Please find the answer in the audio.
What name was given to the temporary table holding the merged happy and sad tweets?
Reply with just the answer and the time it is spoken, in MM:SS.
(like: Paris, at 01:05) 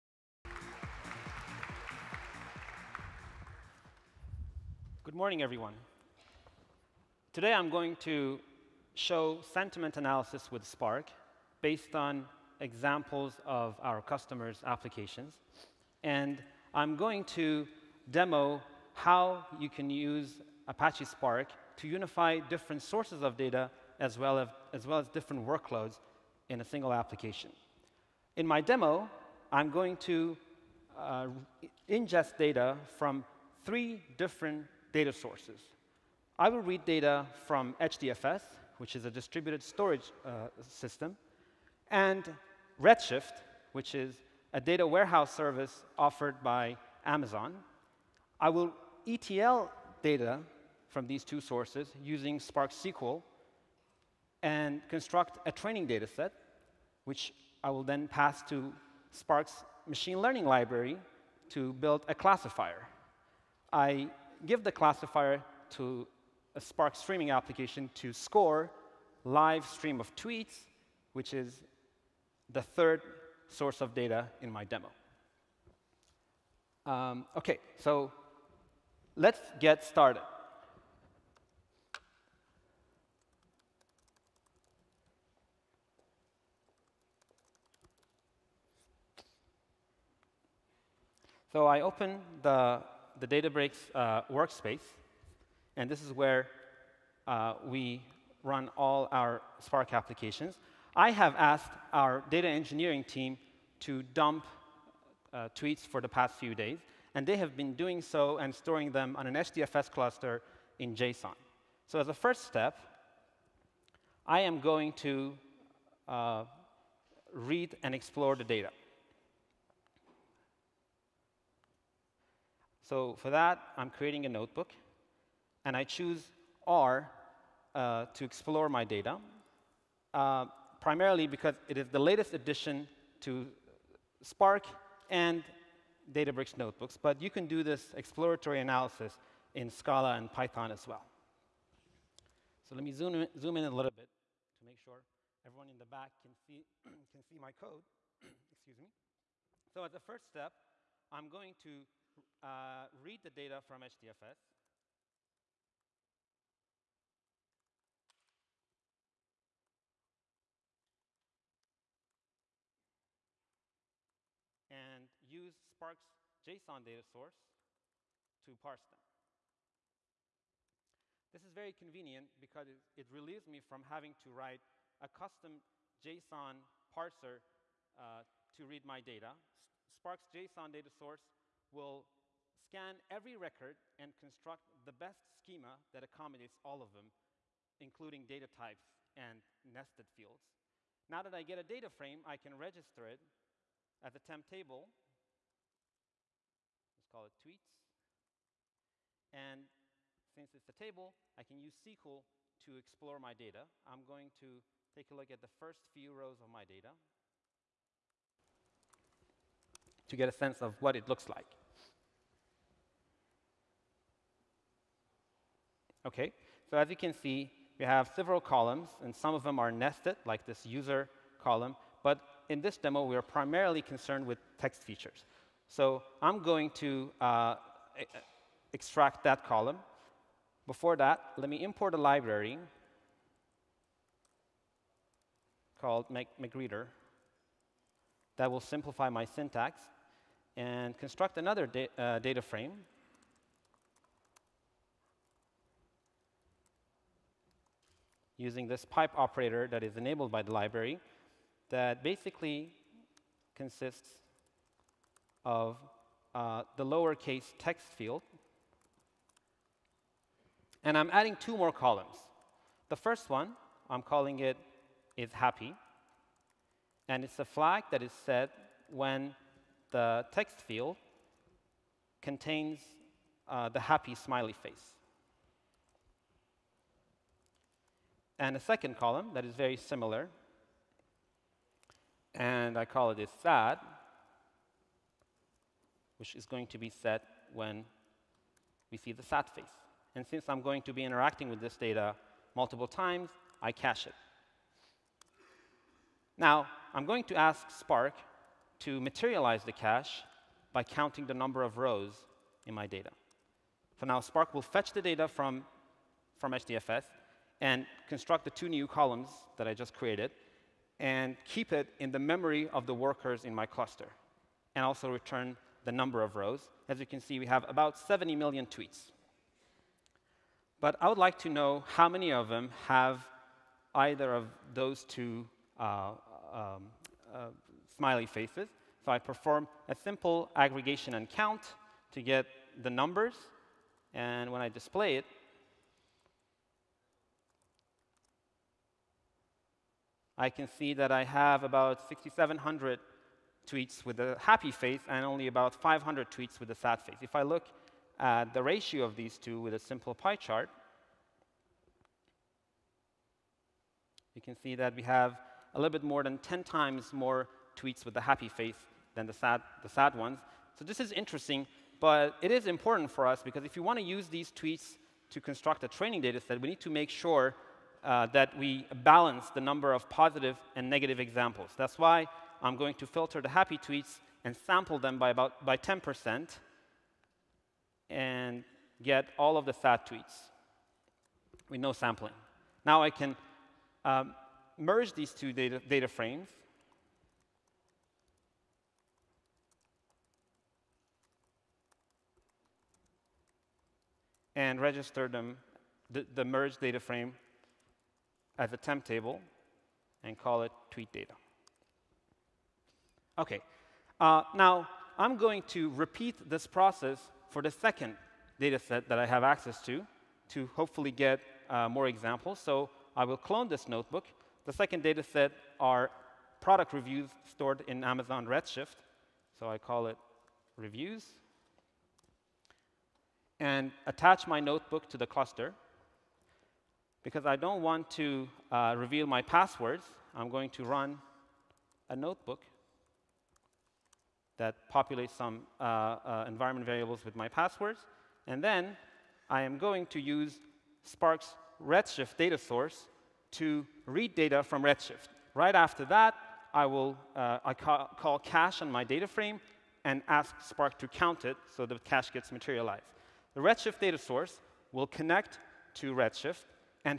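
tweet data, at 06:40.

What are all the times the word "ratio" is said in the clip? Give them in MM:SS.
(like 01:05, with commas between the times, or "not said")
05:48.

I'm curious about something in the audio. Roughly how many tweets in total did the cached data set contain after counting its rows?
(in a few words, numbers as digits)
70 million.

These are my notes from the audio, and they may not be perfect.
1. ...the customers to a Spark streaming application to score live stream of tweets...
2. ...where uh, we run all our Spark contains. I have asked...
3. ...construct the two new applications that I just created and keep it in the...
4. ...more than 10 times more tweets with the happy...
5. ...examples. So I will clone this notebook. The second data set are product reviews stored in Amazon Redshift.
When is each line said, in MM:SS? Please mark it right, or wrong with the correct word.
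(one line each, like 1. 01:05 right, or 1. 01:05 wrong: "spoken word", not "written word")
1. 01:04 wrong: "classifier", not "customers"
2. 01:36 wrong: "applications", not "contains"
3. 05:08 wrong: "columns", not "applications"
4. 05:56 right
5. 06:52 right.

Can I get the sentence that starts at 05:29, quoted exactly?
So I perform a simple aggregation and count to get the numbers.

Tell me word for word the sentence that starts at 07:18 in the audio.
And then I am going to use Spark's Redshift data source to read data from Redshift.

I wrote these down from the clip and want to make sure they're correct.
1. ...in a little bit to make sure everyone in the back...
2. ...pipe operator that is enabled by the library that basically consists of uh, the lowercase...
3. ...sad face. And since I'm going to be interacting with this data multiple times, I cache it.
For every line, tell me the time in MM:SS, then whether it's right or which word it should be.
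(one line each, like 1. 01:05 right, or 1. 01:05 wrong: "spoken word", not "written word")
1. 02:23 right
2. 04:08 right
3. 04:49 right.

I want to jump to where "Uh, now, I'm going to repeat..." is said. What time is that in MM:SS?
06:44.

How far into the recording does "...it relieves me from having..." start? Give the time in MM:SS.
02:52.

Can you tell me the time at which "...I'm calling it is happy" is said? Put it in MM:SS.
04:23.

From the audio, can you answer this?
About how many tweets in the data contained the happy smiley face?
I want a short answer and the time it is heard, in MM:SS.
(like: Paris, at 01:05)
6,700, at 05:42.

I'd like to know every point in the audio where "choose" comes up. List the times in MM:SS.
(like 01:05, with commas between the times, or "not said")
02:05.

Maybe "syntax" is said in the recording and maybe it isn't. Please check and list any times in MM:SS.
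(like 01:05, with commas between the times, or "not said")
03:59.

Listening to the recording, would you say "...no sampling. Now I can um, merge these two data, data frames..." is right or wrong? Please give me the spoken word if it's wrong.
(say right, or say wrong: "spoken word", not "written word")
right.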